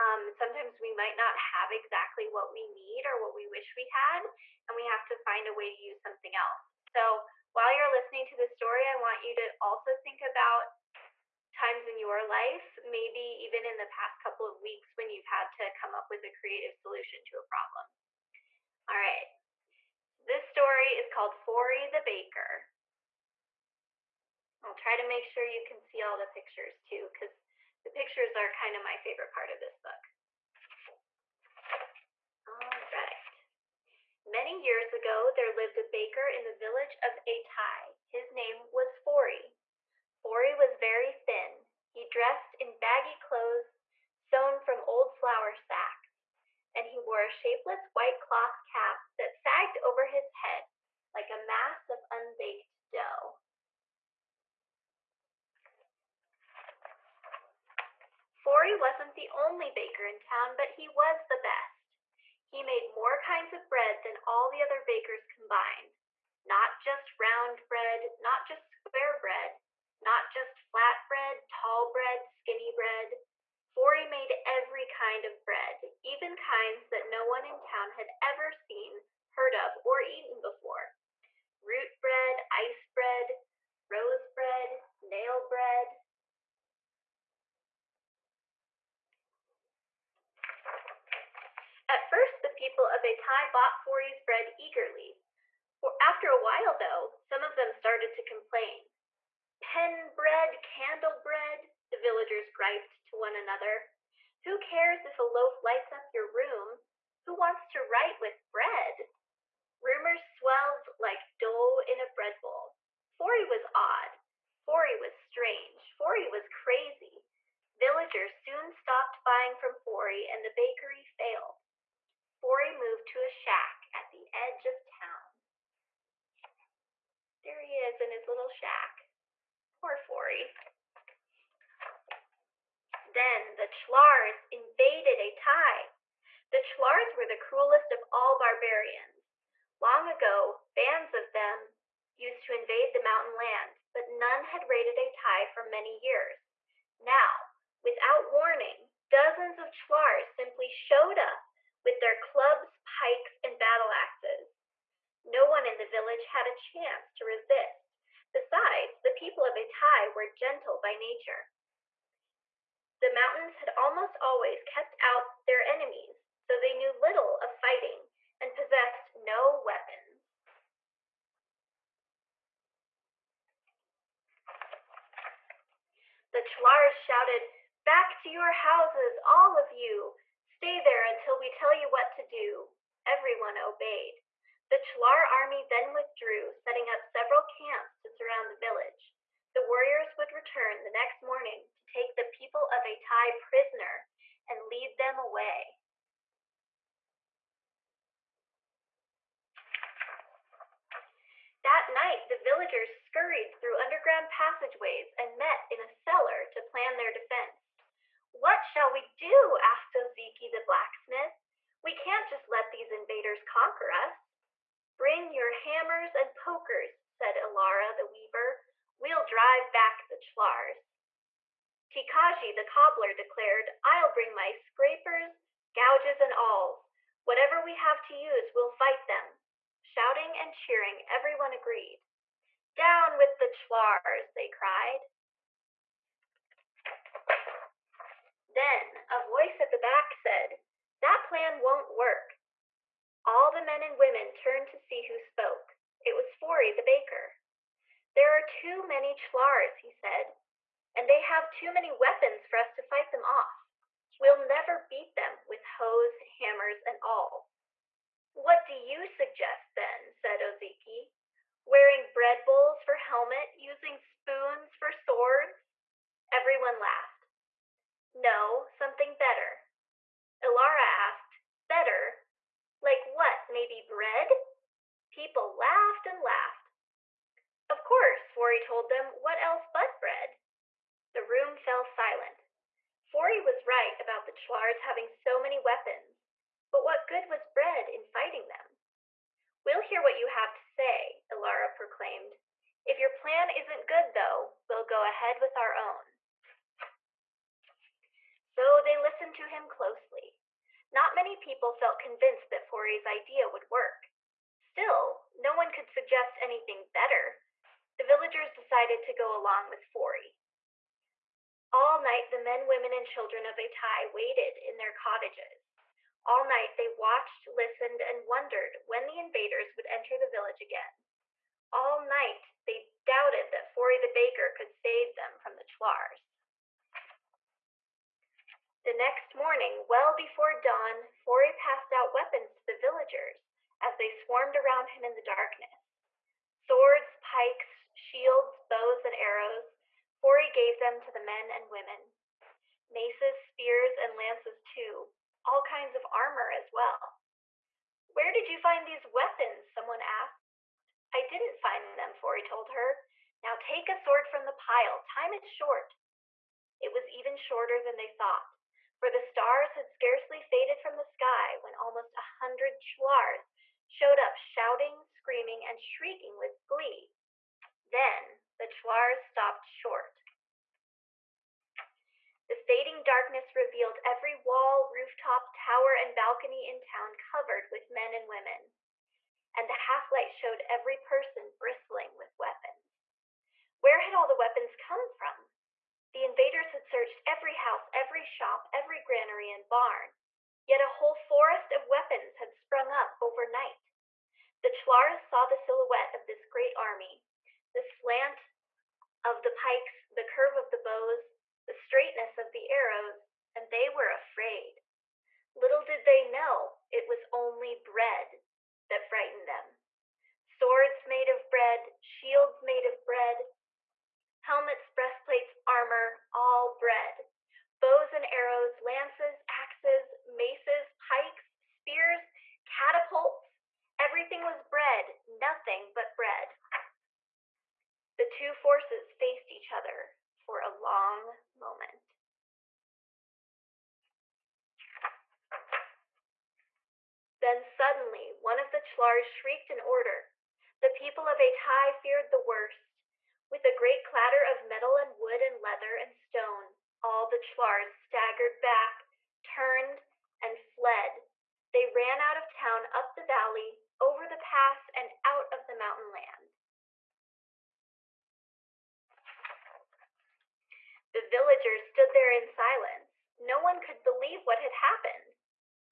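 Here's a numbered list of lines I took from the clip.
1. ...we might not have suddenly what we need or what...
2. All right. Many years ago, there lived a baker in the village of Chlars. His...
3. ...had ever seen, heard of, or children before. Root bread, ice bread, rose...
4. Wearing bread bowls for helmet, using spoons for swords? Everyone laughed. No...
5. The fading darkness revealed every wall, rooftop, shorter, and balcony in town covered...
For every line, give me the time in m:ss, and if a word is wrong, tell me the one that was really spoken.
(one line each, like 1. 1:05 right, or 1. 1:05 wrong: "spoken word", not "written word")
1. 0:00 wrong: "exactly", not "suddenly"
2. 0:32 wrong: "Atai", not "Chlars"
3. 1:17 wrong: "eaten", not "children"
4. 4:21 right
5. 6:12 wrong: "tower", not "shorter".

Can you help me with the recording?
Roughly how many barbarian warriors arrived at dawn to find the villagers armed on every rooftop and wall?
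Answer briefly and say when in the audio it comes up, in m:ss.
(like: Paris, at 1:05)
almost 100, at 6:01.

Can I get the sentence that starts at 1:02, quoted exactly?
He made more kinds of bread than all the other bakers combined.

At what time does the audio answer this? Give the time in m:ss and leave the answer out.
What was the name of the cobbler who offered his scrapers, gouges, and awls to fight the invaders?
3:41.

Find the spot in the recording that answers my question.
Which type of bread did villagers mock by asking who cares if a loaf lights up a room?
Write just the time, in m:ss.
1:40.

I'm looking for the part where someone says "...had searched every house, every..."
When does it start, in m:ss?
6:26.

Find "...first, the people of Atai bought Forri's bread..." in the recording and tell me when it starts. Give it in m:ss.
1:32.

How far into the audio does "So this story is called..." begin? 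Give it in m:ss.
0:20.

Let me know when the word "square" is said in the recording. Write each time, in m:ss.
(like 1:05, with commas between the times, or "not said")
1:08.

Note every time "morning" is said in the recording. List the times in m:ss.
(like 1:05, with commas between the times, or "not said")
3:11, 5:29.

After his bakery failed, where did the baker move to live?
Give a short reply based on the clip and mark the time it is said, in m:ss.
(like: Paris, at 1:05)
a shack at the edge of town, at 2:03.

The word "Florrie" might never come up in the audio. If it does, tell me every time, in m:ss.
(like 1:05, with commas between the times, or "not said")
0:58, 1:13.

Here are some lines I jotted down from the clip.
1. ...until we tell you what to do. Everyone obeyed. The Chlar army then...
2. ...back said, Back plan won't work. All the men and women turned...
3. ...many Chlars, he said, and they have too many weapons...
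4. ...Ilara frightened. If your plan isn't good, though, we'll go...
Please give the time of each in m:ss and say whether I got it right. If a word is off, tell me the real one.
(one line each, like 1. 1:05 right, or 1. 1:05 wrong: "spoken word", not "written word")
1. 3:01 right
2. 3:59 wrong: "That", not "Back"
3. 4:08 right
4. 4:51 wrong: "proclaimed", not "frightened".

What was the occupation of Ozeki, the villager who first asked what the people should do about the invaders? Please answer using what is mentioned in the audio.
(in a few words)
blacksmith.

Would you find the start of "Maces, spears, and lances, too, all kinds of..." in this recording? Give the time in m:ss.
5:42.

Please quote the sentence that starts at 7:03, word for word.
Everything was bread, nothing but bread.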